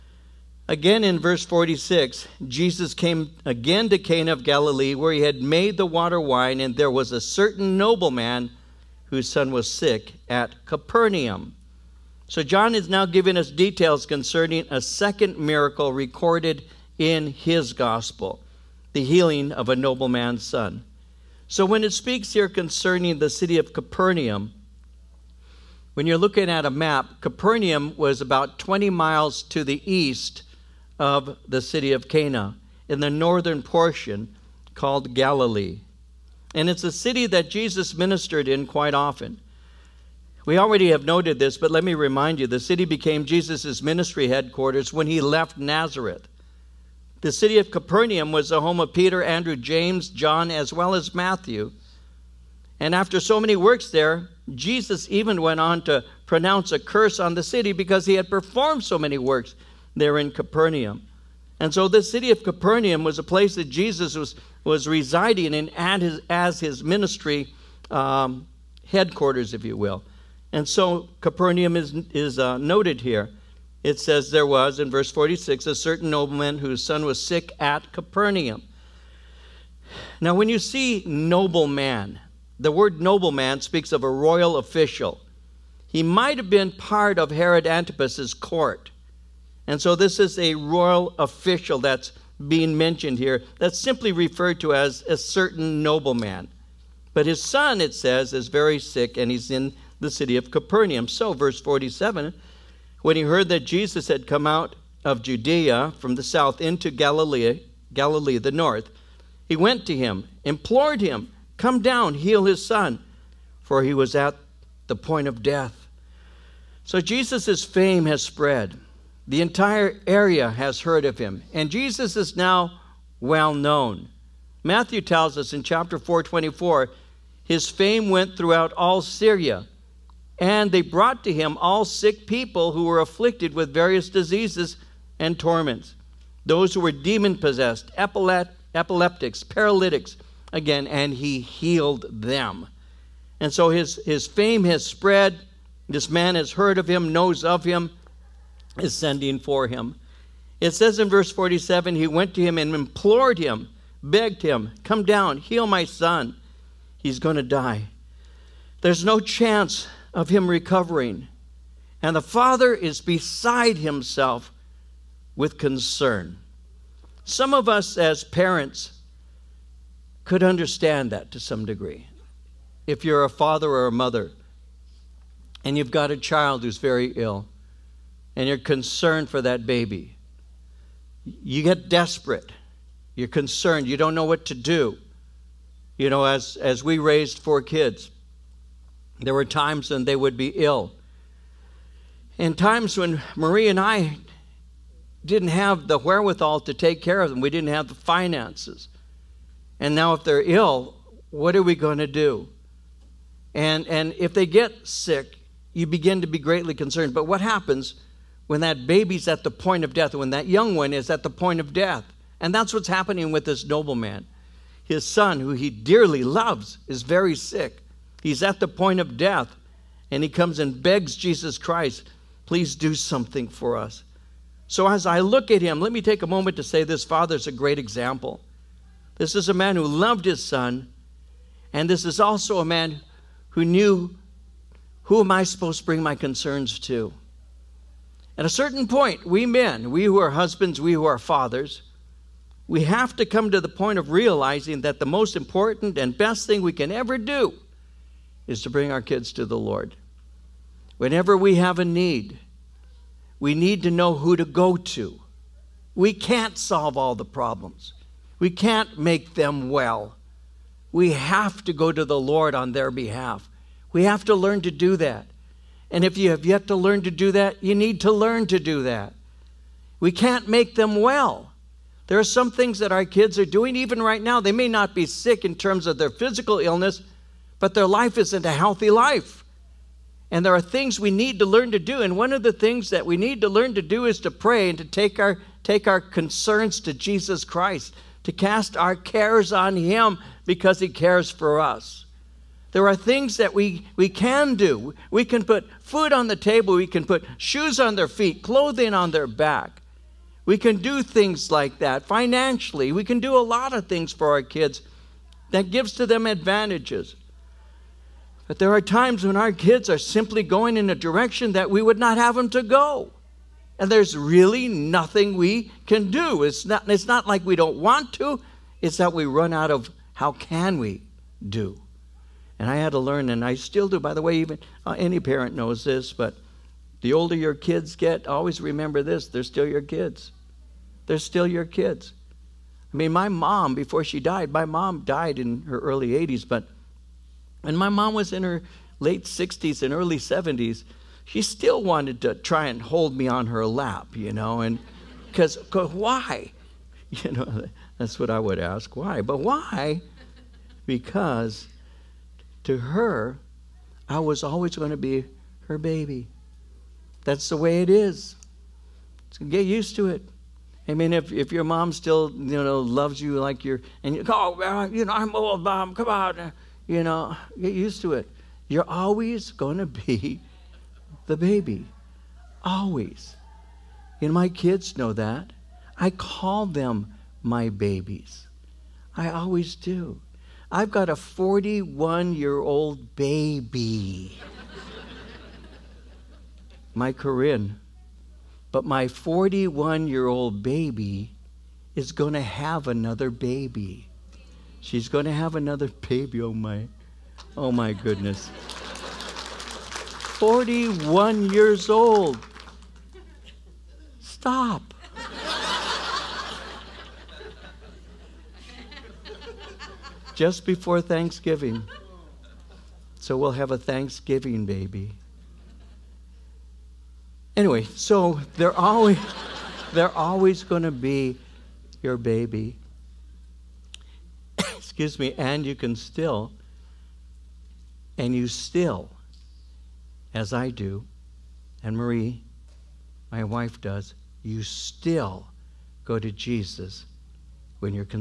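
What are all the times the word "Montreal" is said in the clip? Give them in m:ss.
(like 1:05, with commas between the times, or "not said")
not said.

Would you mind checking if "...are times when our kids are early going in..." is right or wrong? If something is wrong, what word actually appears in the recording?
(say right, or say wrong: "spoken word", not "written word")
wrong: "simply", not "early".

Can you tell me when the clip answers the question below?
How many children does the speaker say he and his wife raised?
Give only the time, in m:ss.
3:07.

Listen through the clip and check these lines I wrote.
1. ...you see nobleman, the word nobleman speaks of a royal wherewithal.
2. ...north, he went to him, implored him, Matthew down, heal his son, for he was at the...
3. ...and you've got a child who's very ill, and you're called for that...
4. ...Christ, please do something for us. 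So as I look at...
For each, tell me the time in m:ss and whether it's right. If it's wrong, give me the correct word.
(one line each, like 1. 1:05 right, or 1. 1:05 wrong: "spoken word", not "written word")
1. 1:20 wrong: "official", not "wherewithal"
2. 1:48 wrong: "Come", not "Matthew"
3. 2:55 wrong: "concerned", not "called"
4. 3:41 right.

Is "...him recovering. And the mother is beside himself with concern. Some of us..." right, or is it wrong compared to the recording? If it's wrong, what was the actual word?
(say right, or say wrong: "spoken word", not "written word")
wrong: "father", not "mother".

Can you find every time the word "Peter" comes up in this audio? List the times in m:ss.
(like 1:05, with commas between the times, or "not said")
0:48.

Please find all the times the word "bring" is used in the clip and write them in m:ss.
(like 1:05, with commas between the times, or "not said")
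3:55, 4:08.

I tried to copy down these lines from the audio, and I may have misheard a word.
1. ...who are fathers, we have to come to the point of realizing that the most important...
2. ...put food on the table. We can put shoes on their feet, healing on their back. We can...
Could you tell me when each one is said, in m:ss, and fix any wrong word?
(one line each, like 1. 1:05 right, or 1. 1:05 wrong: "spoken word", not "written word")
1. 4:00 right
2. 4:55 wrong: "clothing", not "healing".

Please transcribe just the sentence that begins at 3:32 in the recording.
And that's what's happening with this nobleman.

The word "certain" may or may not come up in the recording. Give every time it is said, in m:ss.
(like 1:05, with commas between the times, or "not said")
0:07, 1:15, 1:35, 3:58.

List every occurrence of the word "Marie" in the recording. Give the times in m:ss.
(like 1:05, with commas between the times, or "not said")
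3:13, 7:11.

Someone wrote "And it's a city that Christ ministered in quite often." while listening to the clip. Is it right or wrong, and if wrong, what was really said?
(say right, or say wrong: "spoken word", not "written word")
wrong: "Jesus", not "Christ".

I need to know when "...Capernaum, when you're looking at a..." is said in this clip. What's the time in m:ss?
0:23.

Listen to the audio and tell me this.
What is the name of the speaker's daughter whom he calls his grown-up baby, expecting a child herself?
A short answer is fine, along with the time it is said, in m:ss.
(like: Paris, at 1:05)
Corinne, at 6:27.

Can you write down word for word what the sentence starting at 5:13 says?
And there's really nothing we can do.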